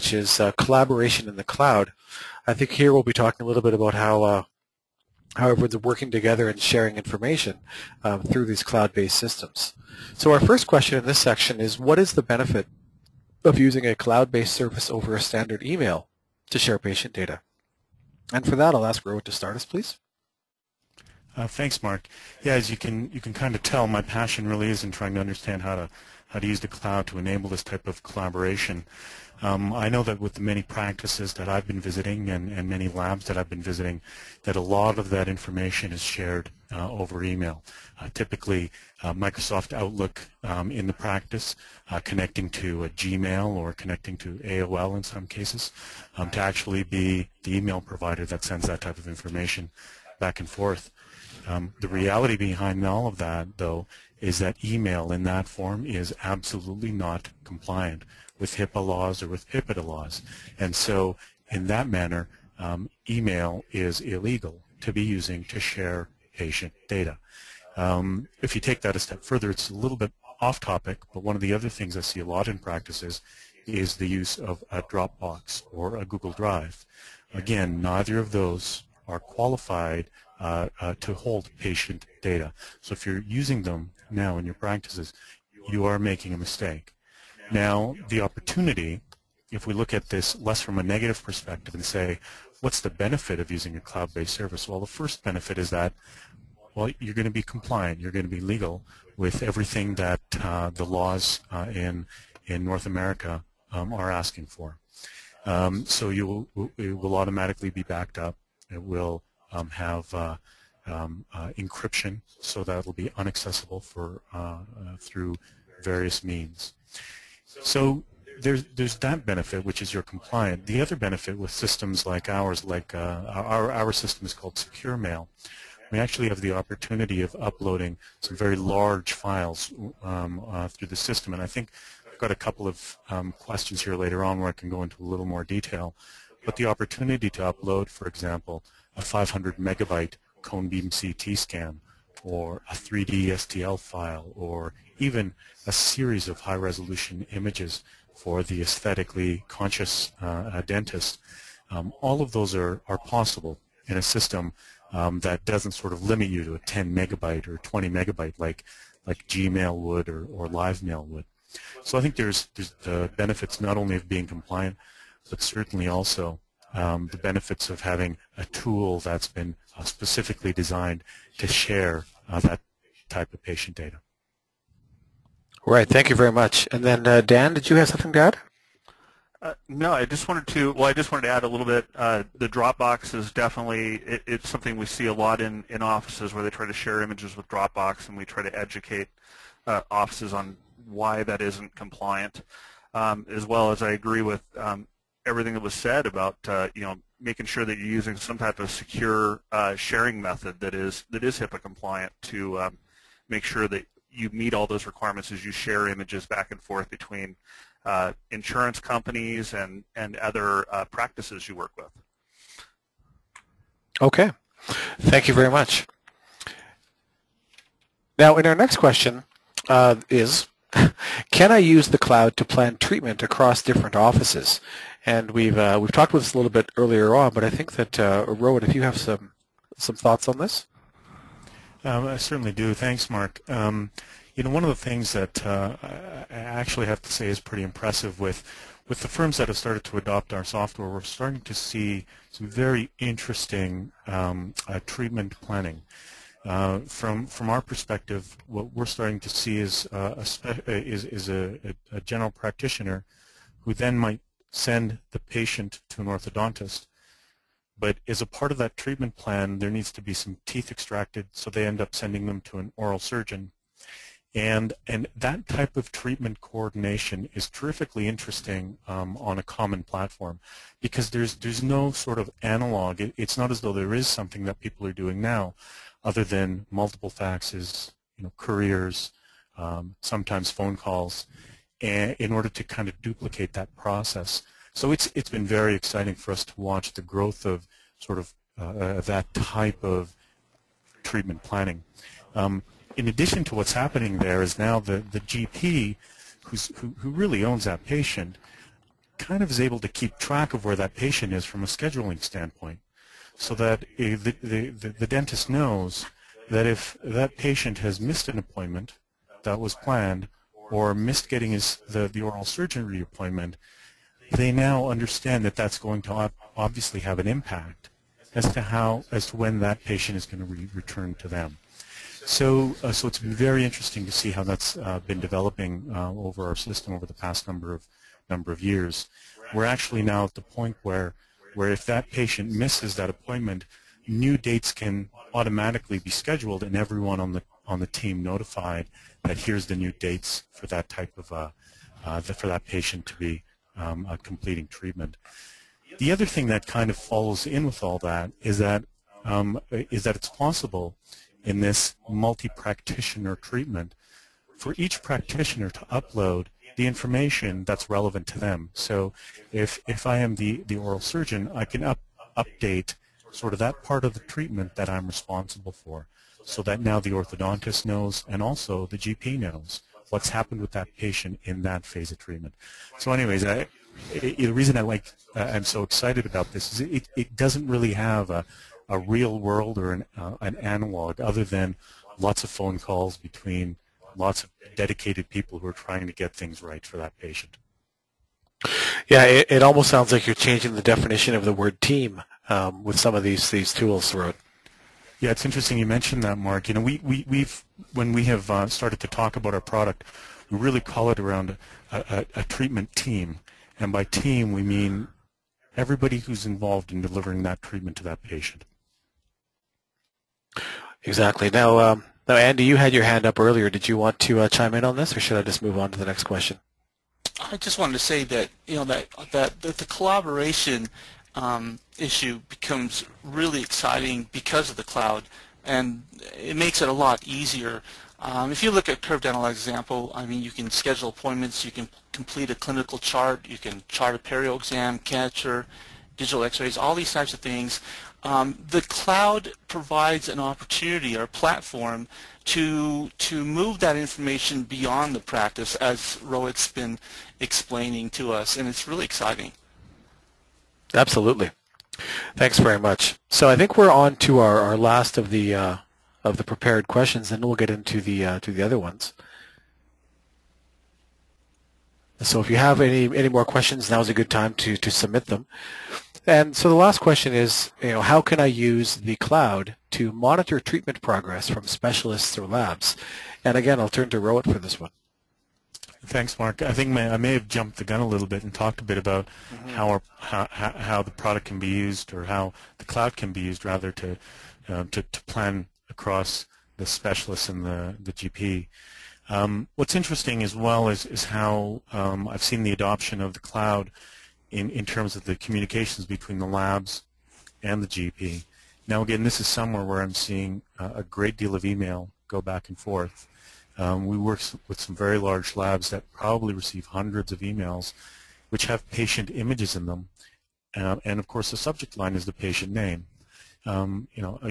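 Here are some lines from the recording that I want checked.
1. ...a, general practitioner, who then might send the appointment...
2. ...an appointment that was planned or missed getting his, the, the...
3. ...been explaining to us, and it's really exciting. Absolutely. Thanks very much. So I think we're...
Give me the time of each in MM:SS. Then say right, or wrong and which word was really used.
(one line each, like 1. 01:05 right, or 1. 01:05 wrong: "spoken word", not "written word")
1. 04:11 wrong: "patient", not "appointment"
2. 05:08 right
3. 07:26 right.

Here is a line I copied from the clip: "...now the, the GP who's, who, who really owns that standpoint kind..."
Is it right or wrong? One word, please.
wrong.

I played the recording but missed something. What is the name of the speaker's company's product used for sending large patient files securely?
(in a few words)
Secure Mail.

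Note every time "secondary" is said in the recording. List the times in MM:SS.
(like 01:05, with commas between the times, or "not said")
not said.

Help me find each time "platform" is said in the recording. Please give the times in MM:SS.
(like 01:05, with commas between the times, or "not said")
04:29, 07:21.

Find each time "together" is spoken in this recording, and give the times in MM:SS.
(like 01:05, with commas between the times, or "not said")
00:06.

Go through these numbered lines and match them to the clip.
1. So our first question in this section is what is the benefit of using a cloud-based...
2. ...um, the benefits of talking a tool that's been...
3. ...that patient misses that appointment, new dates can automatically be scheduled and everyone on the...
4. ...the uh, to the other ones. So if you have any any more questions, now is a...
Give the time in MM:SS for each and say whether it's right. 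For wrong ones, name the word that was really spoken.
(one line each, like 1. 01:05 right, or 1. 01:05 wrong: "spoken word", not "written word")
1. 00:10 right
2. 02:46 wrong: "having", not "talking"
3. 05:31 right
4. 07:37 right.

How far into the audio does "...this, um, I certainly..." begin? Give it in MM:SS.
03:50.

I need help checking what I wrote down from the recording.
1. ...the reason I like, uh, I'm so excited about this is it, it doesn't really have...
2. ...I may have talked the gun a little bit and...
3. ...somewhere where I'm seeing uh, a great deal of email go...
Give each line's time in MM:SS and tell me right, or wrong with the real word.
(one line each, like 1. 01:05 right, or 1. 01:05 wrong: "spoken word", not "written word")
1. 06:14 right
2. 07:56 wrong: "jumped", not "talked"
3. 08:19 right.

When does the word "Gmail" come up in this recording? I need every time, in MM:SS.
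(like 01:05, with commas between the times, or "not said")
00:42, 02:39.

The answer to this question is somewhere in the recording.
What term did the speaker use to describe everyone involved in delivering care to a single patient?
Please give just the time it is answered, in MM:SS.
06:42.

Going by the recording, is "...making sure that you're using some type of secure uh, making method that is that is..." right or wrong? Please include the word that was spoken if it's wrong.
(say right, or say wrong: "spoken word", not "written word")
wrong: "sharing", not "making".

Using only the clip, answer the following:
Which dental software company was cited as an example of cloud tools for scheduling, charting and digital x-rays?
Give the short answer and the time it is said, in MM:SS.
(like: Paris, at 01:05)
Curve Dental, at 07:09.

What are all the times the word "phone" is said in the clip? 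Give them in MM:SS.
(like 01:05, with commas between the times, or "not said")
04:40, 06:22.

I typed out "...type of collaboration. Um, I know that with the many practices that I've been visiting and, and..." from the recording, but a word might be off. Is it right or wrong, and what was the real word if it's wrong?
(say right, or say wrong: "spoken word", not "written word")
right.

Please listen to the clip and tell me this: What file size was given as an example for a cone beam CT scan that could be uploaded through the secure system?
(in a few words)
500 megabytes.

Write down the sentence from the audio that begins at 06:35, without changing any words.
Yeah, it's interesting you mentioned that, Mark.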